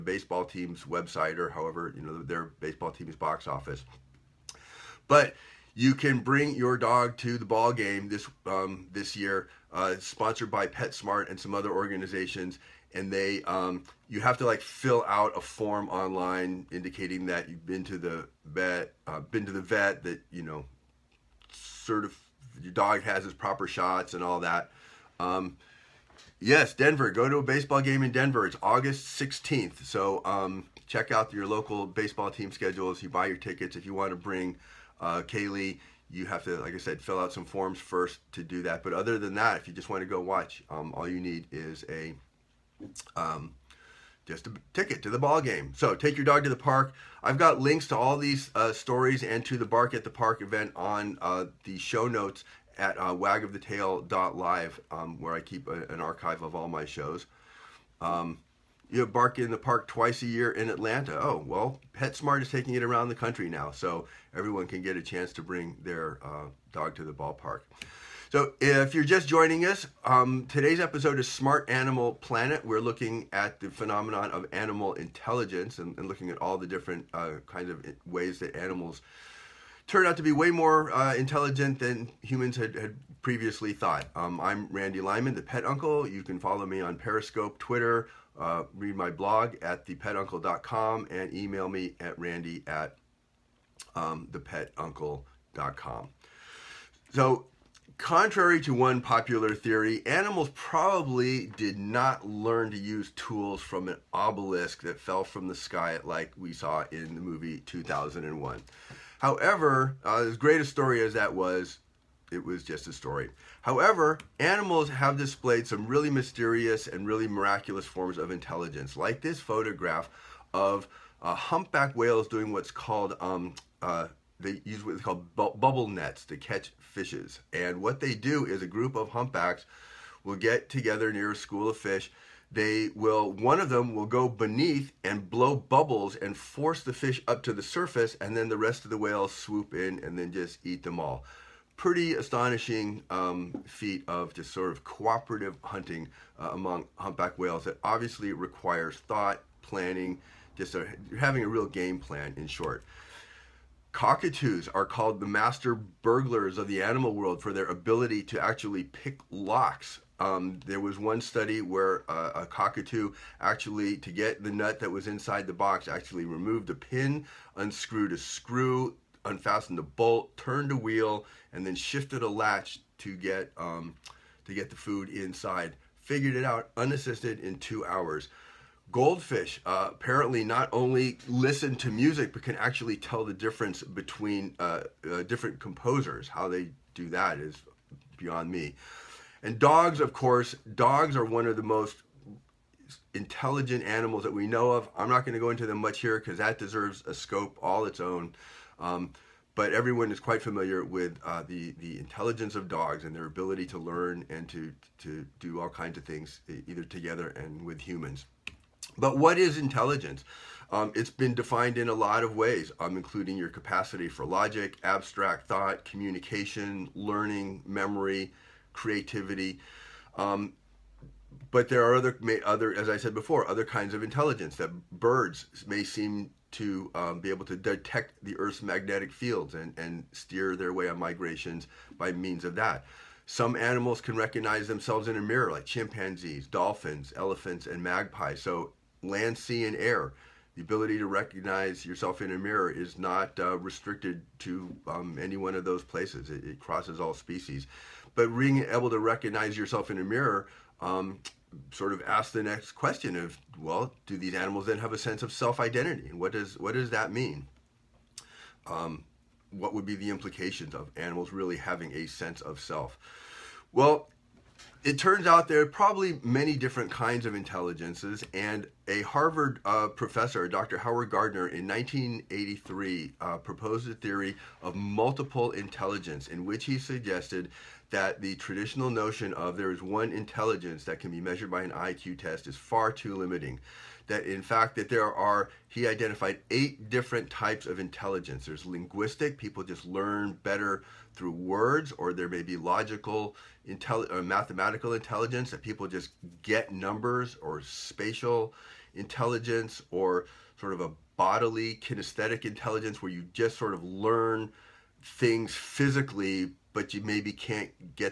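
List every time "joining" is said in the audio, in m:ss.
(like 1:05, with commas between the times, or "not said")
1:09.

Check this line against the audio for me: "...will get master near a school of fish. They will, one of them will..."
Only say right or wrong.
wrong.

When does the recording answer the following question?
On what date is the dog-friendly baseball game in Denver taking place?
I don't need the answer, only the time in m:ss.
0:28.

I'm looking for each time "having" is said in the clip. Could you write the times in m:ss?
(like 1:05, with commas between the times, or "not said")
2:31, 4:21.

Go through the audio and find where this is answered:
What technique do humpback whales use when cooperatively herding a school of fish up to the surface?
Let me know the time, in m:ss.
2:05.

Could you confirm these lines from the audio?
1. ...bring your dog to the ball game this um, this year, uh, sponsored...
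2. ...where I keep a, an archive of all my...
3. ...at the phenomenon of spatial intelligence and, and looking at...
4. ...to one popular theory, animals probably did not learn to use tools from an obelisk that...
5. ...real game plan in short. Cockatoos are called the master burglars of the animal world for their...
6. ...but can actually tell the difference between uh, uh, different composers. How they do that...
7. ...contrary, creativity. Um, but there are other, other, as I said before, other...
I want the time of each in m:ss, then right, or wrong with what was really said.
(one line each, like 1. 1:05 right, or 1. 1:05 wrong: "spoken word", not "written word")
1. 0:06 right
2. 0:55 right
3. 1:13 wrong: "animal", not "spatial"
4. 1:38 right
5. 2:31 right
6. 3:02 right
7. 3:37 wrong: "memory", not "contrary".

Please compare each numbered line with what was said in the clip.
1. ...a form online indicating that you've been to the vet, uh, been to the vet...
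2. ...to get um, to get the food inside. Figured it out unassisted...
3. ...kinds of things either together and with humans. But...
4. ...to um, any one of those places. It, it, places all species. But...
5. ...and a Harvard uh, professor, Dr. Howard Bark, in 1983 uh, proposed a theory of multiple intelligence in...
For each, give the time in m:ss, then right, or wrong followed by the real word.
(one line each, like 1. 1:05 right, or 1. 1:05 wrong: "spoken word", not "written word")
1. 0:15 right
2. 2:52 right
3. 3:25 right
4. 4:04 wrong: "crosses", not "places"
5. 4:28 wrong: "Gardner", not "Bark".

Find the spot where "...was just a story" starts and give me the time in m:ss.
1:52.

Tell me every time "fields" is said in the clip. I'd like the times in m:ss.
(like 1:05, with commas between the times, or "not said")
3:49.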